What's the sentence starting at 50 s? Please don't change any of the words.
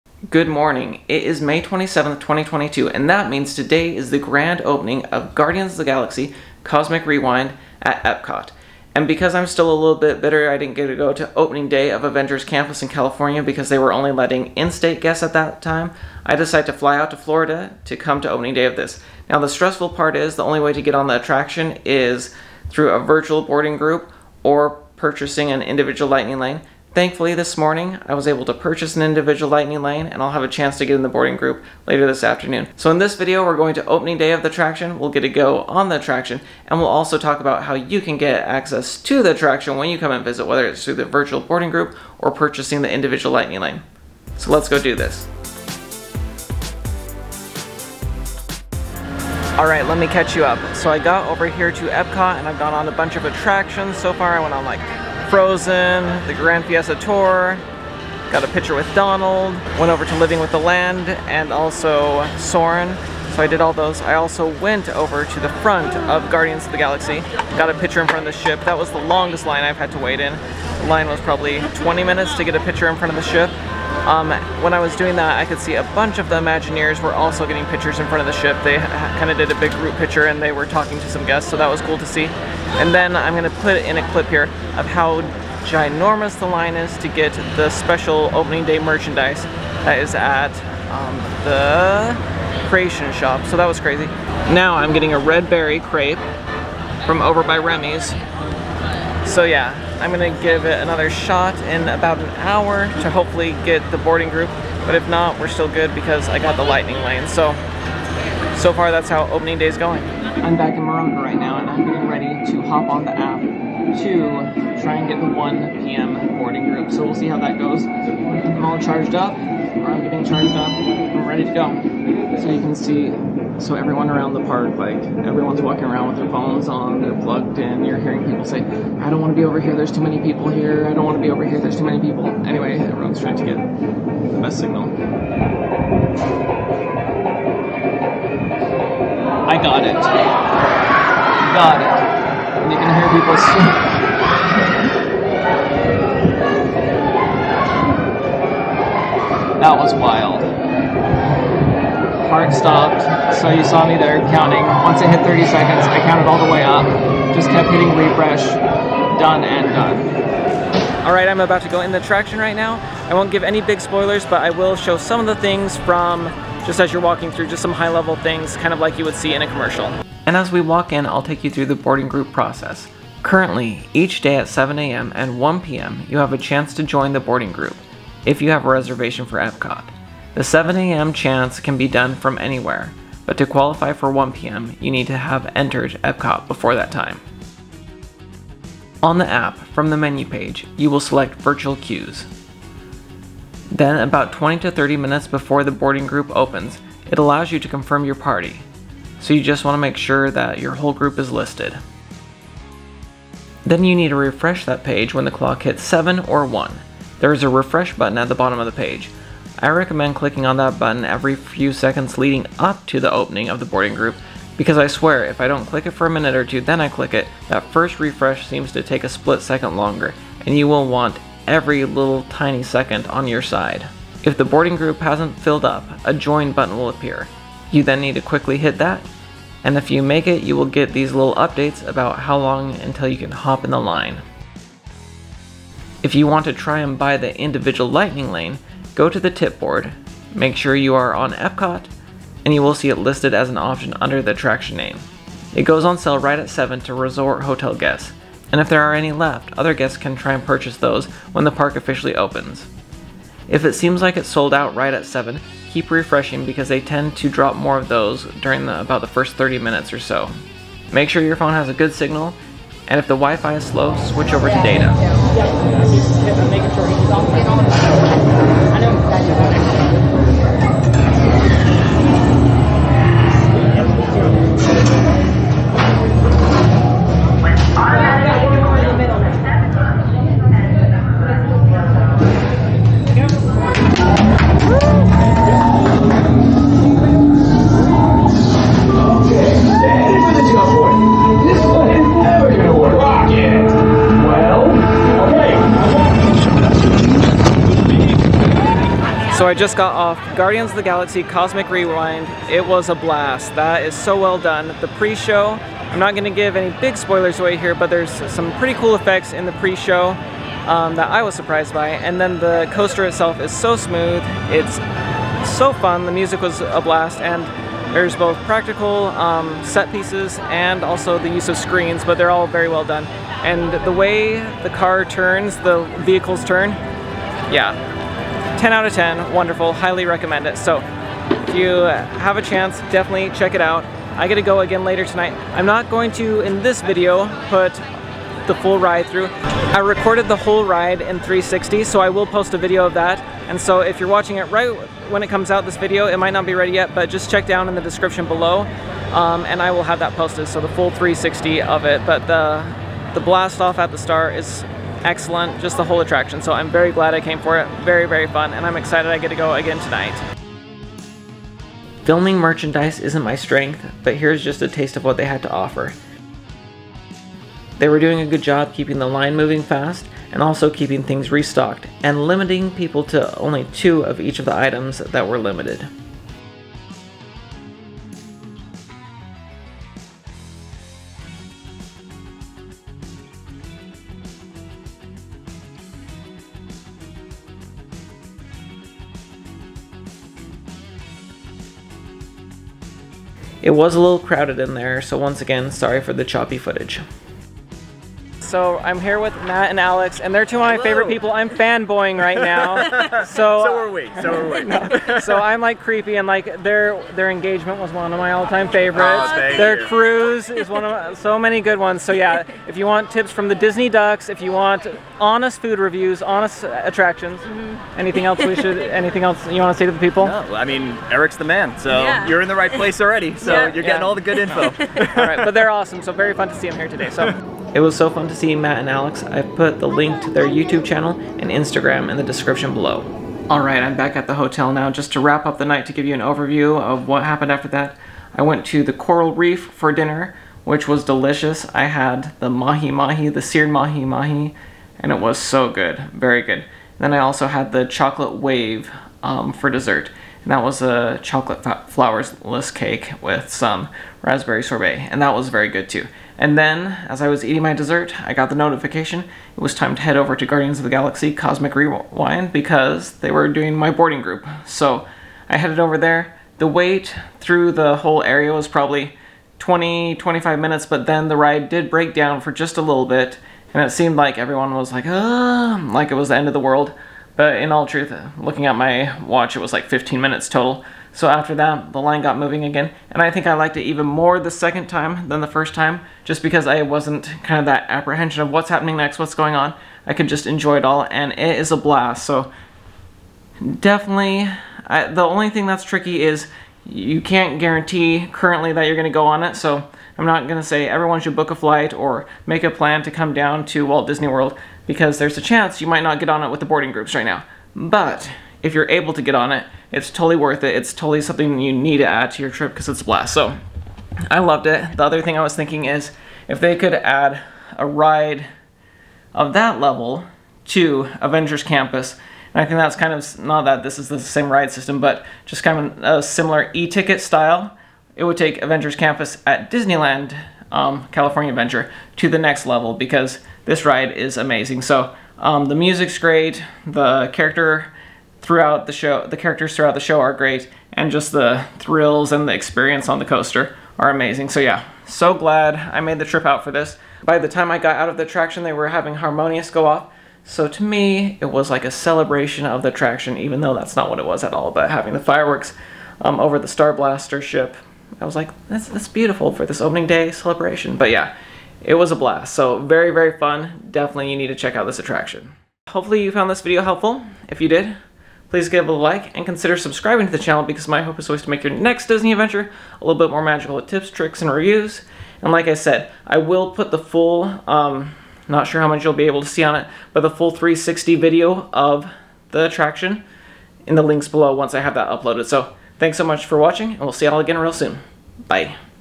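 So I got over here to Epcot and I've gone on a bunch of attractions.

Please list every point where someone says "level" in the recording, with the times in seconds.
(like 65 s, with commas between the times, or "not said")
167 s, 519 s, 532 s.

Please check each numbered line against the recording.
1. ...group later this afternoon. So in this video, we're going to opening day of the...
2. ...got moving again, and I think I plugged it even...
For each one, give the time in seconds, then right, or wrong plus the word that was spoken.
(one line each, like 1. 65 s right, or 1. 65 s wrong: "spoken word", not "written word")
1. 31 s right
2. 482 s wrong: "liked", not "plugged".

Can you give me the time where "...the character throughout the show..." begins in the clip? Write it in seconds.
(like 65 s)
536 s.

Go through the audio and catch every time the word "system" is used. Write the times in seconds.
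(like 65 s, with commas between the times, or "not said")
524 s.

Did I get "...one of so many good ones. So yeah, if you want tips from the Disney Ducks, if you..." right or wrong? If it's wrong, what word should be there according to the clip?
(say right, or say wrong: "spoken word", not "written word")
right.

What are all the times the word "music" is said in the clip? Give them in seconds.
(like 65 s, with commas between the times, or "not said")
316 s, 535 s.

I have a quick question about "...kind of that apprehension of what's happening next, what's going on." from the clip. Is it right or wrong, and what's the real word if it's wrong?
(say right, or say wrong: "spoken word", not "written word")
right.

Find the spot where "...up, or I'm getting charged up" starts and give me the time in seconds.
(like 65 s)
119 s.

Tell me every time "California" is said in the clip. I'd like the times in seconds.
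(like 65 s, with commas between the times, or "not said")
12 s, 531 s.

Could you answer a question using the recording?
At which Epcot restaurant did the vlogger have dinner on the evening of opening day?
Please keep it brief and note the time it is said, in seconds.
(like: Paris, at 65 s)
Coral Reef, at 438 s.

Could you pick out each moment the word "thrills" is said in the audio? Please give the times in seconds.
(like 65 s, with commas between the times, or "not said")
541 s.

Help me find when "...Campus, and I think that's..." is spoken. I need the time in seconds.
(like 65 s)
521 s.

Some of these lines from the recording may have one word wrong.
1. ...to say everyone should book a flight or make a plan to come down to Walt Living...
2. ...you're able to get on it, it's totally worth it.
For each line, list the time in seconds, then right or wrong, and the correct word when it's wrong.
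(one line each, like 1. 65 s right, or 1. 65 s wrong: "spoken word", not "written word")
1. 500 s wrong: "Disney", not "Living"
2. 508 s right.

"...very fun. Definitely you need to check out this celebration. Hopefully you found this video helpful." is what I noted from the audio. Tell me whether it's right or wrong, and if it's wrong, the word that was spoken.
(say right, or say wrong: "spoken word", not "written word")
wrong: "attraction", not "celebration".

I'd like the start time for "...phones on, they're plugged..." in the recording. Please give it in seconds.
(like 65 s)
126 s.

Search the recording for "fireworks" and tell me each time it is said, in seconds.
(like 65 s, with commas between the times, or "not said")
555 s.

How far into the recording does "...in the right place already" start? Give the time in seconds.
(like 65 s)
422 s.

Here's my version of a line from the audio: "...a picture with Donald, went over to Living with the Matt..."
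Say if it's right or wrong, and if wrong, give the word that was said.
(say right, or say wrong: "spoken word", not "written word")
wrong: "Land", not "Matt".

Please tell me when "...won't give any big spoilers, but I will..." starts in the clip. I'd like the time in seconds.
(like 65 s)
163 s.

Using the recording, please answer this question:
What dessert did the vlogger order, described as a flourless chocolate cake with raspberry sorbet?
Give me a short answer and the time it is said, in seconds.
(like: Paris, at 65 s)
chocolate wave, at 447 s.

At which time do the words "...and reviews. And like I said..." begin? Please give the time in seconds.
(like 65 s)
574 s.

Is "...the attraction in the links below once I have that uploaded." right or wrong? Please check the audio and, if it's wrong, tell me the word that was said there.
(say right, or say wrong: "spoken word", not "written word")
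right.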